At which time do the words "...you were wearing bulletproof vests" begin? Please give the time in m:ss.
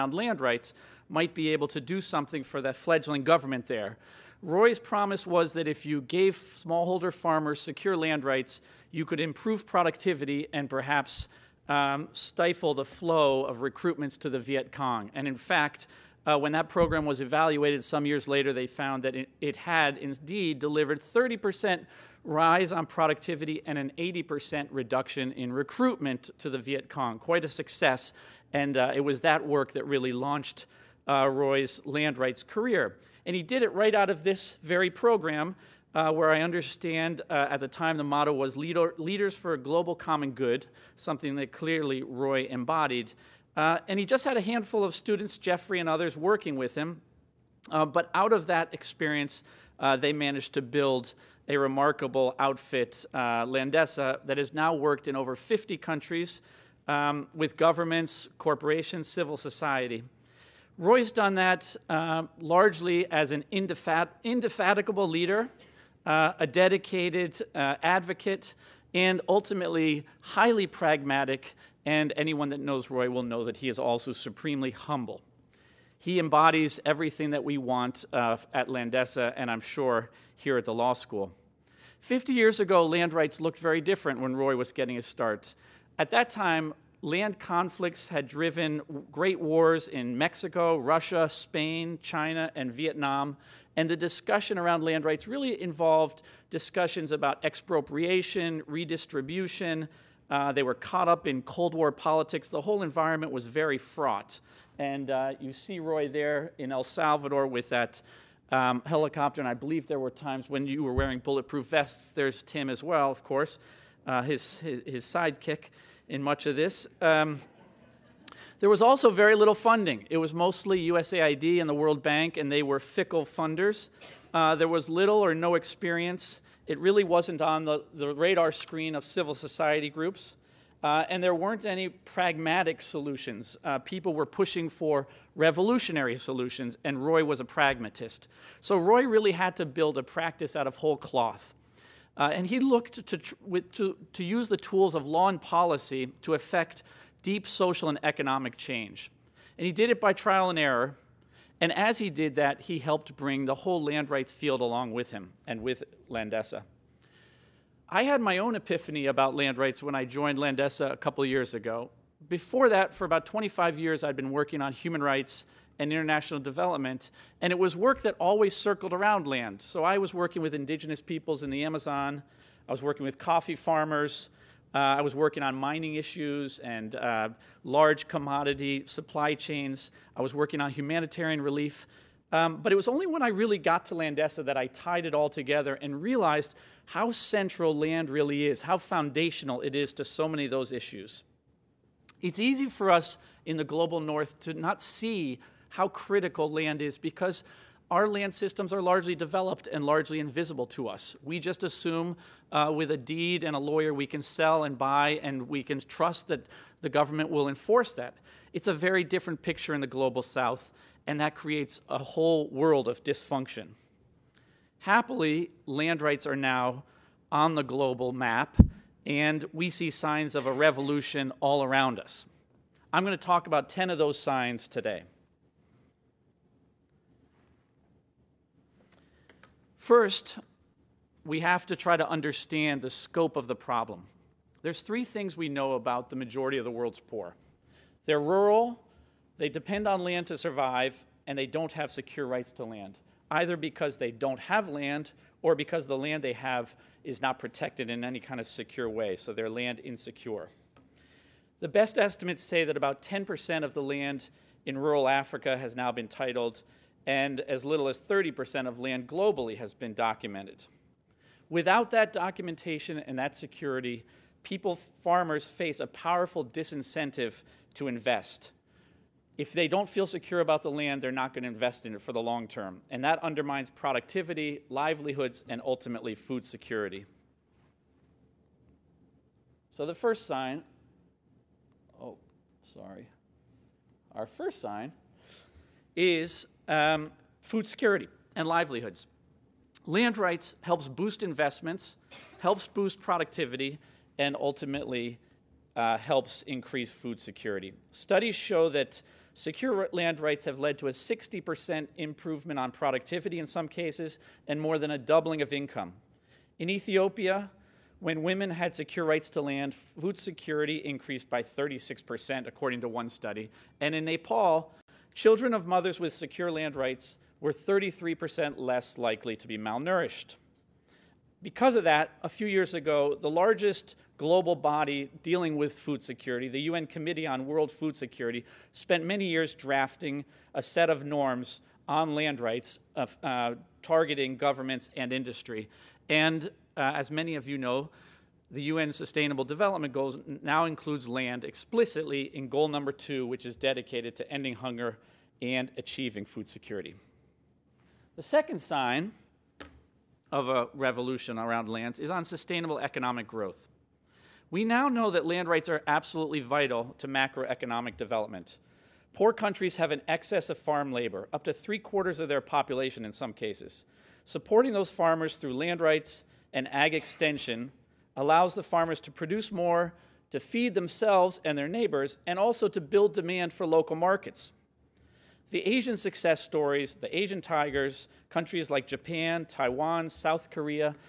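1:50.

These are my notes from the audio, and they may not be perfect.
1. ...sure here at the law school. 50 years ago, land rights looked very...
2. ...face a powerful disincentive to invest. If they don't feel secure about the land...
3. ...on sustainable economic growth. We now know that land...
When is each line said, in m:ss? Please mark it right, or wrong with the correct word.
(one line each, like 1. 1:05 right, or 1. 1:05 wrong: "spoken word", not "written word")
1. 1:19 right
2. 4:25 right
3. 5:52 right.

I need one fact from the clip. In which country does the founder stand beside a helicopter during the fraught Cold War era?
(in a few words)
El Salvador.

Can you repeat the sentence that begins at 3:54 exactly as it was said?
There's three things we know about the majority of the world's poor.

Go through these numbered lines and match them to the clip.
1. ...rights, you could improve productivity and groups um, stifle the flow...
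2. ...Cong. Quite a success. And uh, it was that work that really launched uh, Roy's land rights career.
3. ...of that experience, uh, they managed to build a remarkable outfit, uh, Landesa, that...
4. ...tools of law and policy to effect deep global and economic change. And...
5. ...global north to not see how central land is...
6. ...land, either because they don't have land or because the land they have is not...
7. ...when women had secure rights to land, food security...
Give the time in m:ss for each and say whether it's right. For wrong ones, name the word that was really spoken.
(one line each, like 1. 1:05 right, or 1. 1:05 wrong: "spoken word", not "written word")
1. 0:08 wrong: "perhaps", not "groups"
2. 0:26 right
3. 0:48 right
4. 2:24 wrong: "social", not "global"
5. 3:13 wrong: "critical", not "central"
6. 4:02 right
7. 5:07 right.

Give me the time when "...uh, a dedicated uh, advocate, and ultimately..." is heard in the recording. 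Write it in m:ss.
1:06.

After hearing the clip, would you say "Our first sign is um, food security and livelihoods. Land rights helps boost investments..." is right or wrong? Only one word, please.
right.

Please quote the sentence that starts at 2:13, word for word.
Uh, people were pushing for revolutionary solutions, and Roy was a pragmatist.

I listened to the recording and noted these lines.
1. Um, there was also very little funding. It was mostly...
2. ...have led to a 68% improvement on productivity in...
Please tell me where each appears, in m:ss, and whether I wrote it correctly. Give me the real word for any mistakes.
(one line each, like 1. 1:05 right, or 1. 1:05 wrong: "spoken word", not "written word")
1. 1:57 right
2. 5:00 wrong: "60", not "68".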